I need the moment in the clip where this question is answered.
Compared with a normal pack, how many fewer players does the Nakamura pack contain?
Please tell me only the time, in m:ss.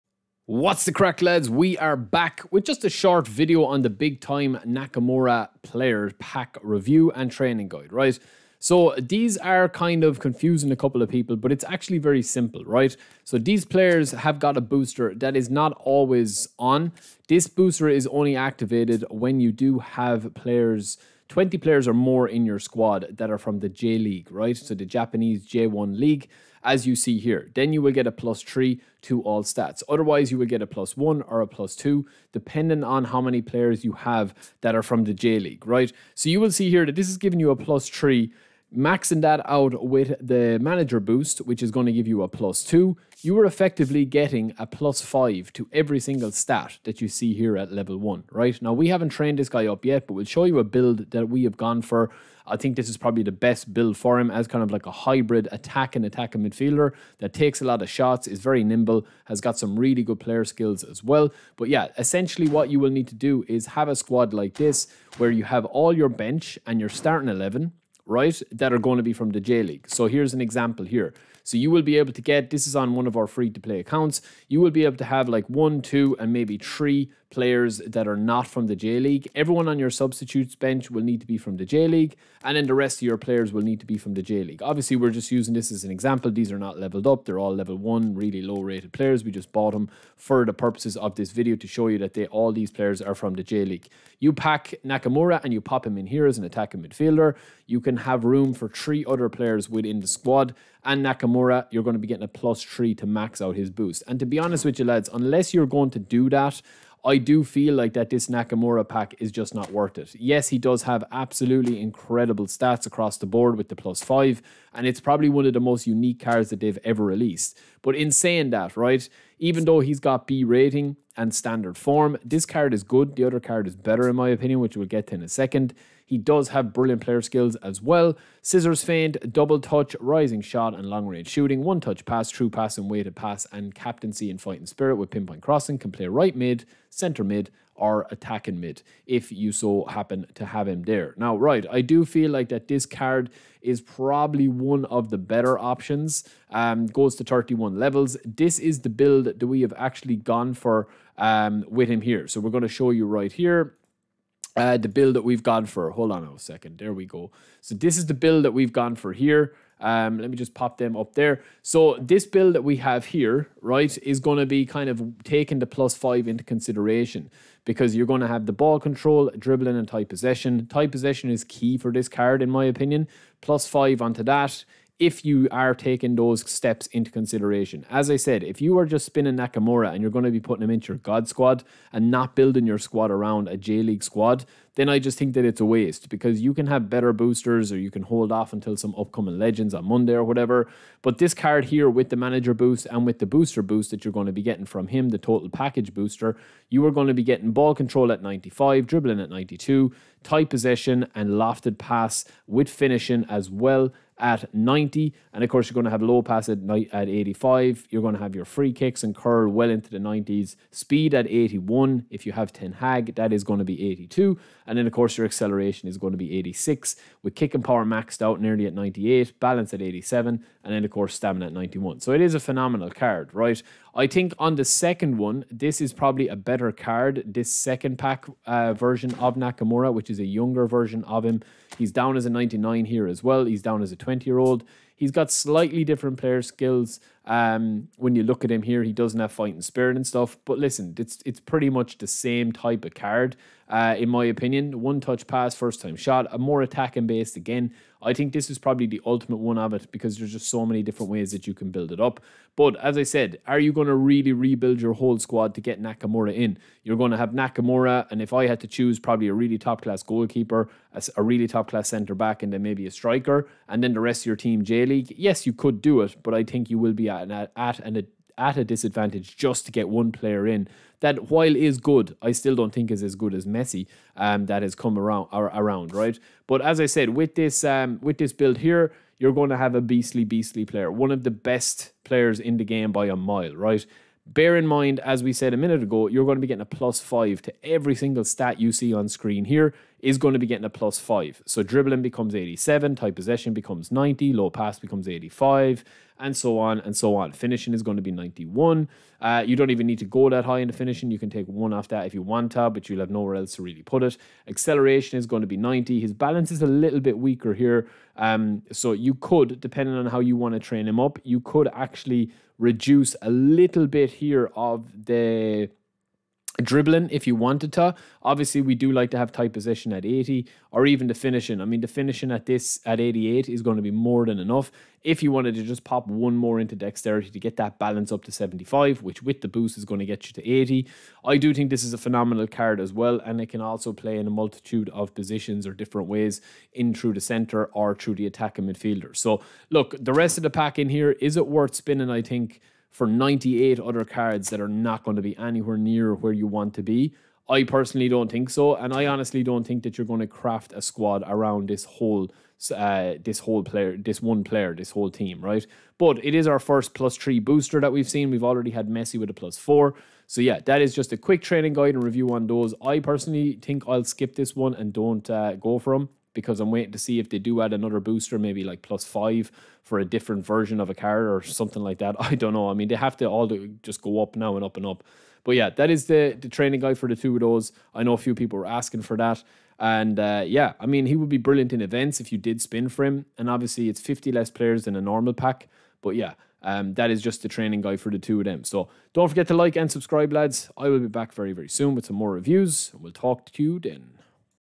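6:23.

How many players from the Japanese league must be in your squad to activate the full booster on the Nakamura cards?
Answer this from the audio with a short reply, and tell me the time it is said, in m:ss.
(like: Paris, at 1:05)
20, at 0:21.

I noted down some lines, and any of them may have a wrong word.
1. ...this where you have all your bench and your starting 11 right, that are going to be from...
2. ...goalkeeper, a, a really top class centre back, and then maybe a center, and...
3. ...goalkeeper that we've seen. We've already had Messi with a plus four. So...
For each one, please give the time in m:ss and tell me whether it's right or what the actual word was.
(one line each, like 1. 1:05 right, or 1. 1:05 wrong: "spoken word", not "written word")
1. 1:04 right
2. 4:20 wrong: "striker", not "center"
3. 5:57 wrong: "booster", not "goalkeeper".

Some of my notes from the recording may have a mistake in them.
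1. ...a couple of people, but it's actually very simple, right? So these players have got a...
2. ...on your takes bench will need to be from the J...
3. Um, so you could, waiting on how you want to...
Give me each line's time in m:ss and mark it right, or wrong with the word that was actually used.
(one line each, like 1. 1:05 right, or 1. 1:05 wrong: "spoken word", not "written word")
1. 0:10 right
2. 1:19 wrong: "substitutes", not "takes"
3. 5:08 wrong: "depending", not "waiting".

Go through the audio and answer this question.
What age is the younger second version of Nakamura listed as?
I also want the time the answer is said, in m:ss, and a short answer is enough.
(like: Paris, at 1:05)
20, at 3:54.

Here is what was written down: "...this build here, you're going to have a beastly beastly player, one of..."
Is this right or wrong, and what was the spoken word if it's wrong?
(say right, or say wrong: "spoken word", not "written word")
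right.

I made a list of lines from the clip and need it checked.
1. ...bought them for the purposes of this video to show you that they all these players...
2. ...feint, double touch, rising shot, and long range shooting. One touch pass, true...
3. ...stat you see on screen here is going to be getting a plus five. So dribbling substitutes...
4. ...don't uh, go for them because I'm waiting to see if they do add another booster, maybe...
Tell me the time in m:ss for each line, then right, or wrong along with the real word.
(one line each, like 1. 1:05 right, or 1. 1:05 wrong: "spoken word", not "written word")
1. 1:29 right
2. 2:08 right
3. 4:48 wrong: "becomes", not "substitutes"
4. 6:04 right.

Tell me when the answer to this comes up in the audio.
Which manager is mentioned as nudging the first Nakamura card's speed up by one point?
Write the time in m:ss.
3:32.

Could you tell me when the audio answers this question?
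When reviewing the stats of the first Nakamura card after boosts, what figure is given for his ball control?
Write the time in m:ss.
3:17.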